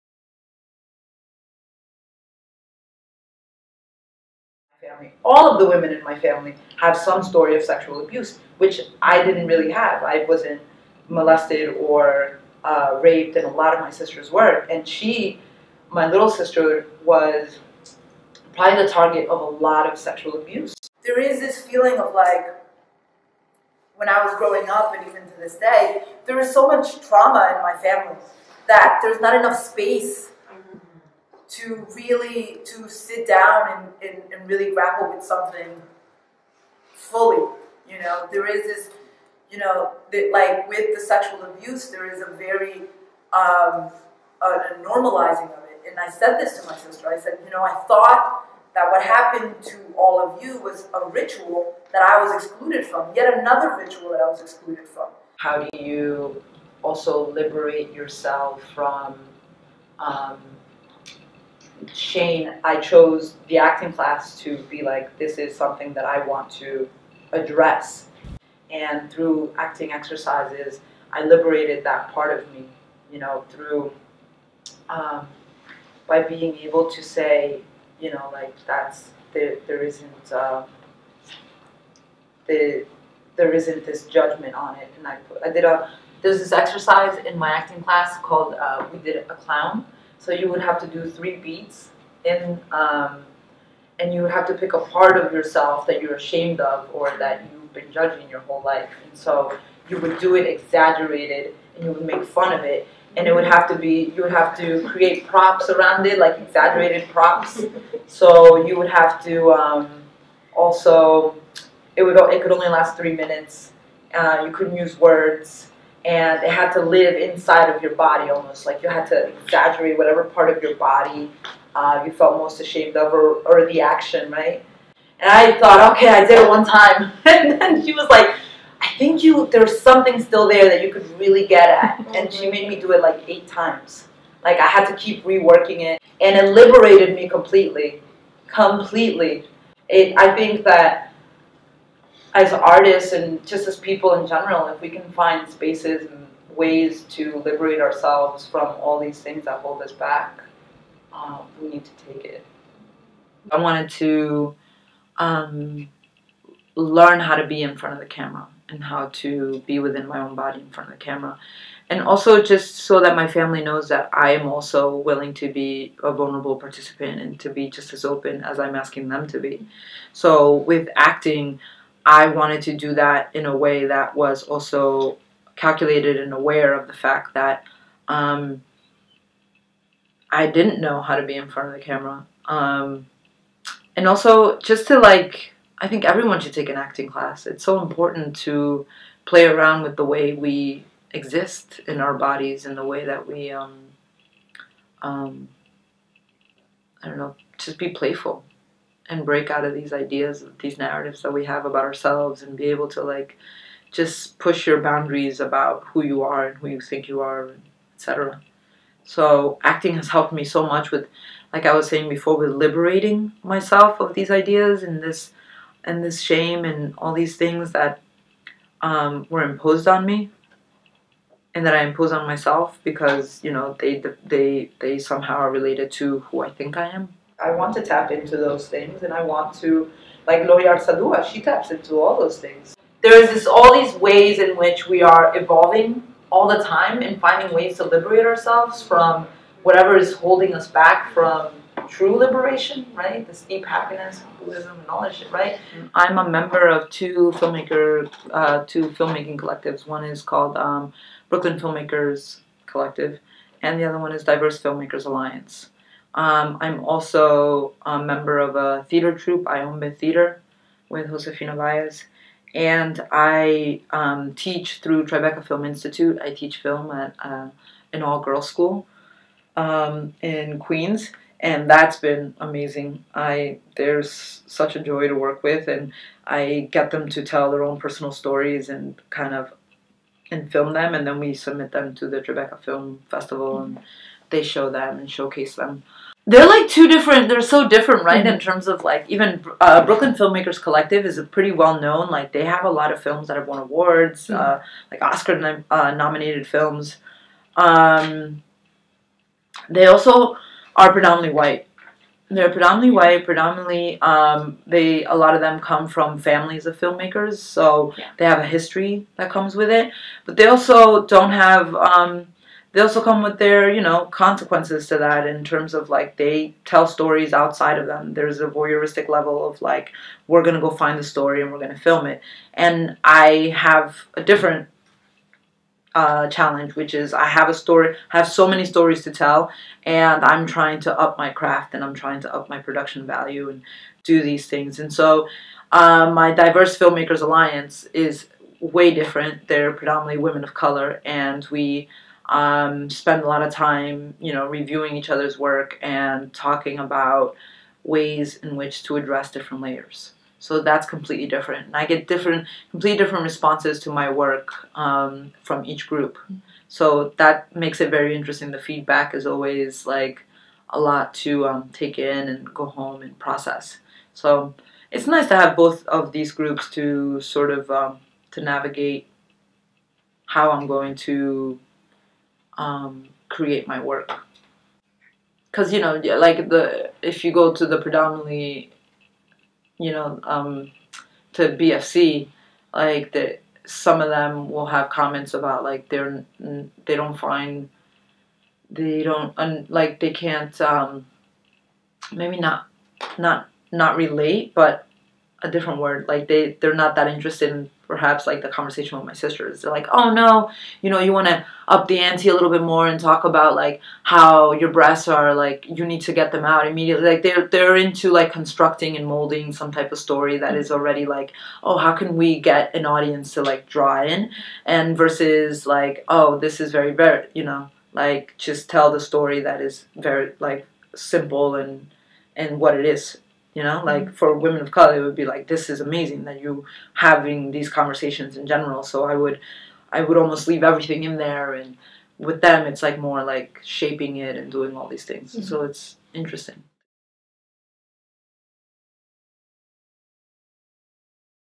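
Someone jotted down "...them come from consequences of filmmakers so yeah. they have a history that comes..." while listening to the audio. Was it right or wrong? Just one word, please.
wrong.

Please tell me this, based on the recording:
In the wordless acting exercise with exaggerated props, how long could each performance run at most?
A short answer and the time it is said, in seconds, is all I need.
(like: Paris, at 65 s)
3 minutes, at 112 s.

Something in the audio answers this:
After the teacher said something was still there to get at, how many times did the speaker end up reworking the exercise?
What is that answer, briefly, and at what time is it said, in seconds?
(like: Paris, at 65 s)
8, at 133 s.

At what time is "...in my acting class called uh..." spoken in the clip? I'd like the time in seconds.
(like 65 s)
87 s.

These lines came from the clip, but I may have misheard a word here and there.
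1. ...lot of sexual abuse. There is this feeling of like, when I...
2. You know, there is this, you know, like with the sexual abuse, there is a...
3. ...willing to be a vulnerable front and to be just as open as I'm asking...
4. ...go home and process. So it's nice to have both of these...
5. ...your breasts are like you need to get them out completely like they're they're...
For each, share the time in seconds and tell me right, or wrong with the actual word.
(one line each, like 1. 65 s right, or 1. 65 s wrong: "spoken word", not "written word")
1. 19 s right
2. 37 s right
3. 164 s wrong: "participant", not "front"
4. 362 s right
5. 404 s wrong: "immediately", not "completely".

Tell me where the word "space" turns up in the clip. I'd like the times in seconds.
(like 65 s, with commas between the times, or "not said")
29 s, 145 s.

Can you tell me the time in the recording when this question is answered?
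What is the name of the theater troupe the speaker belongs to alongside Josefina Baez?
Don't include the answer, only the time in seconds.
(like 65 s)
259 s.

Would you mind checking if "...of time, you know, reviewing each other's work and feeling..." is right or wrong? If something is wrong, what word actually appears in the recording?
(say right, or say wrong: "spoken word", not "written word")
wrong: "talking", not "feeling".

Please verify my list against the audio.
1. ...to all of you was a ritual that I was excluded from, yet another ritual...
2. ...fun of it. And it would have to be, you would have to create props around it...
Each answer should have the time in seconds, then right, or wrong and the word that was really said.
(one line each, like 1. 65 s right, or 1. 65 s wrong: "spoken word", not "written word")
1. 49 s right
2. 102 s right.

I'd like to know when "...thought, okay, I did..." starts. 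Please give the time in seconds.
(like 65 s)
125 s.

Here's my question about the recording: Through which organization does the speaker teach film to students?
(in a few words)
Tribeca Film Institute.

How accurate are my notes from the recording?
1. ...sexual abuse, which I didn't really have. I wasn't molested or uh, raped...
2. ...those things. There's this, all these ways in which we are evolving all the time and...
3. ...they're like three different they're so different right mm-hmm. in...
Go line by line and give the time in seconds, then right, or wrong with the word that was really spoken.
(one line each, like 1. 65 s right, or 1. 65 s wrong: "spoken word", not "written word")
1. 7 s right
2. 232 s right
3. 286 s wrong: "two", not "three".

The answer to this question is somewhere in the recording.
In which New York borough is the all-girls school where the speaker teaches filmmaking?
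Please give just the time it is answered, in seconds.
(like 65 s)
270 s.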